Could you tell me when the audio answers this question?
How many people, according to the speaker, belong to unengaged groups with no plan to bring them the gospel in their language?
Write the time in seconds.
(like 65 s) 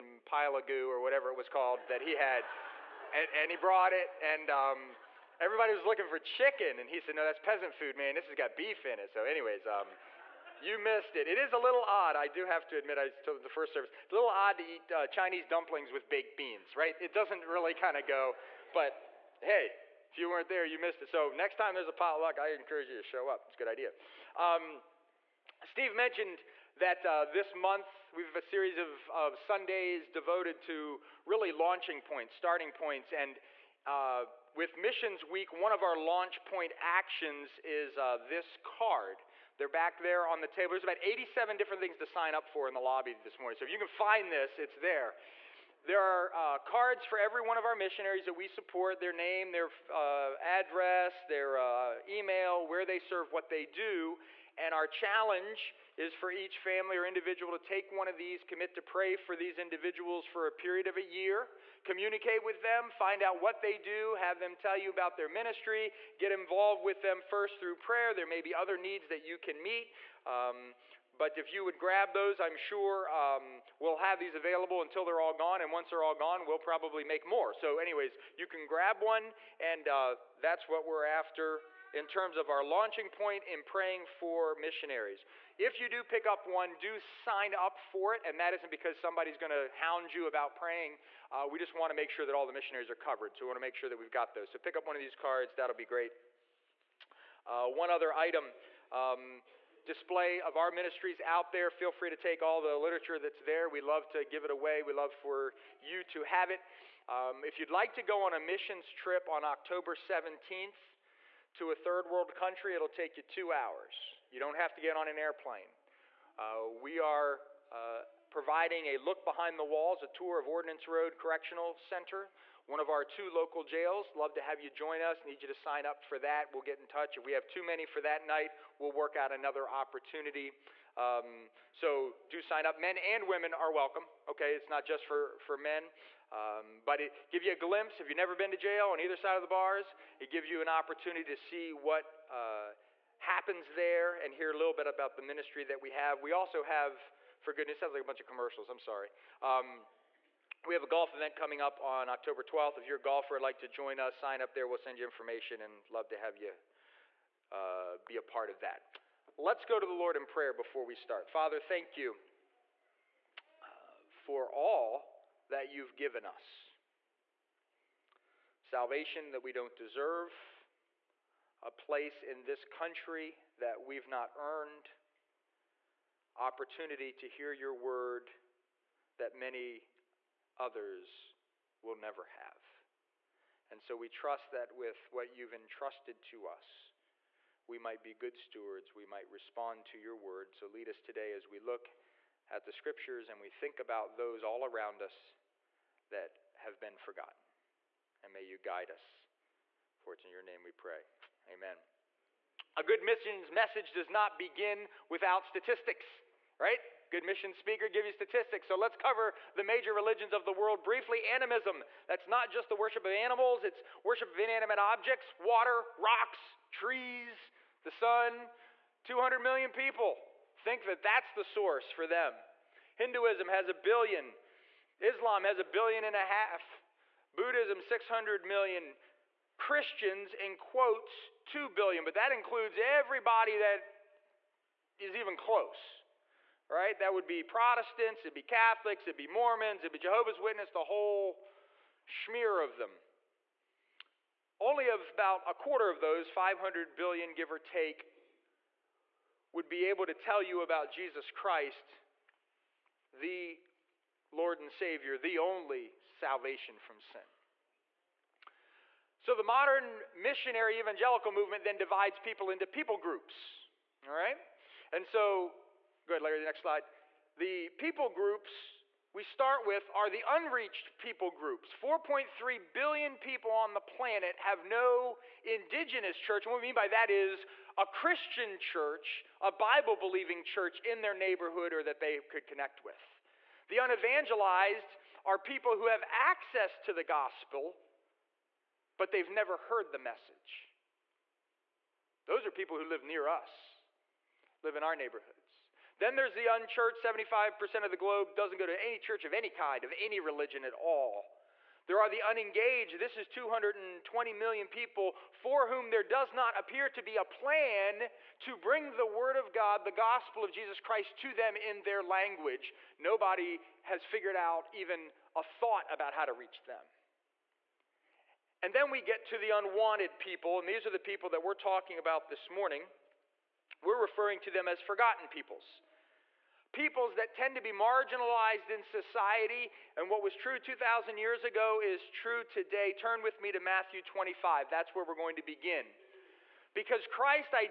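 303 s.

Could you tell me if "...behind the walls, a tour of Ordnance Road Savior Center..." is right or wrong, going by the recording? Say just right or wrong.
wrong.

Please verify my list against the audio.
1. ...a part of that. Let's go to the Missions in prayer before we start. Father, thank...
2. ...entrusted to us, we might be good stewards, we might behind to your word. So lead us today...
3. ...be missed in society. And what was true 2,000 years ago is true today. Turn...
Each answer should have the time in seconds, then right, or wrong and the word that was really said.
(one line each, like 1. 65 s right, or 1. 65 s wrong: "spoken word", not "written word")
1. 158 s wrong: "Lord", not "Missions"
2. 185 s wrong: "respond", not "behind"
3. 327 s wrong: "marginalized", not "missed".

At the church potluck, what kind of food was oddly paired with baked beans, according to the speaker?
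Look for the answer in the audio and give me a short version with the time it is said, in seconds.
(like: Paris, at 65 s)
Chinese dumplings, at 15 s.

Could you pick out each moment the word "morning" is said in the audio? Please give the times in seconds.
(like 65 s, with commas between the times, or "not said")
43 s, 322 s.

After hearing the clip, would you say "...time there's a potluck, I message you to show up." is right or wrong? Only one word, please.
wrong.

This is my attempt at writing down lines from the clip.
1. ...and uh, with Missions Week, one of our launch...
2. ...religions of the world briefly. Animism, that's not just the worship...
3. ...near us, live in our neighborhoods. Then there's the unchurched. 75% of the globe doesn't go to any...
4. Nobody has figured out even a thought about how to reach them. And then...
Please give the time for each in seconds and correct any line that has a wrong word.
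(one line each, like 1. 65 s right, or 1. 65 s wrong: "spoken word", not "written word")
1. 33 s right
2. 209 s right
3. 293 s right
4. 312 s right.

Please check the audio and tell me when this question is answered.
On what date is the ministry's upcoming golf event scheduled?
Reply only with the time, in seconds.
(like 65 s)
152 s.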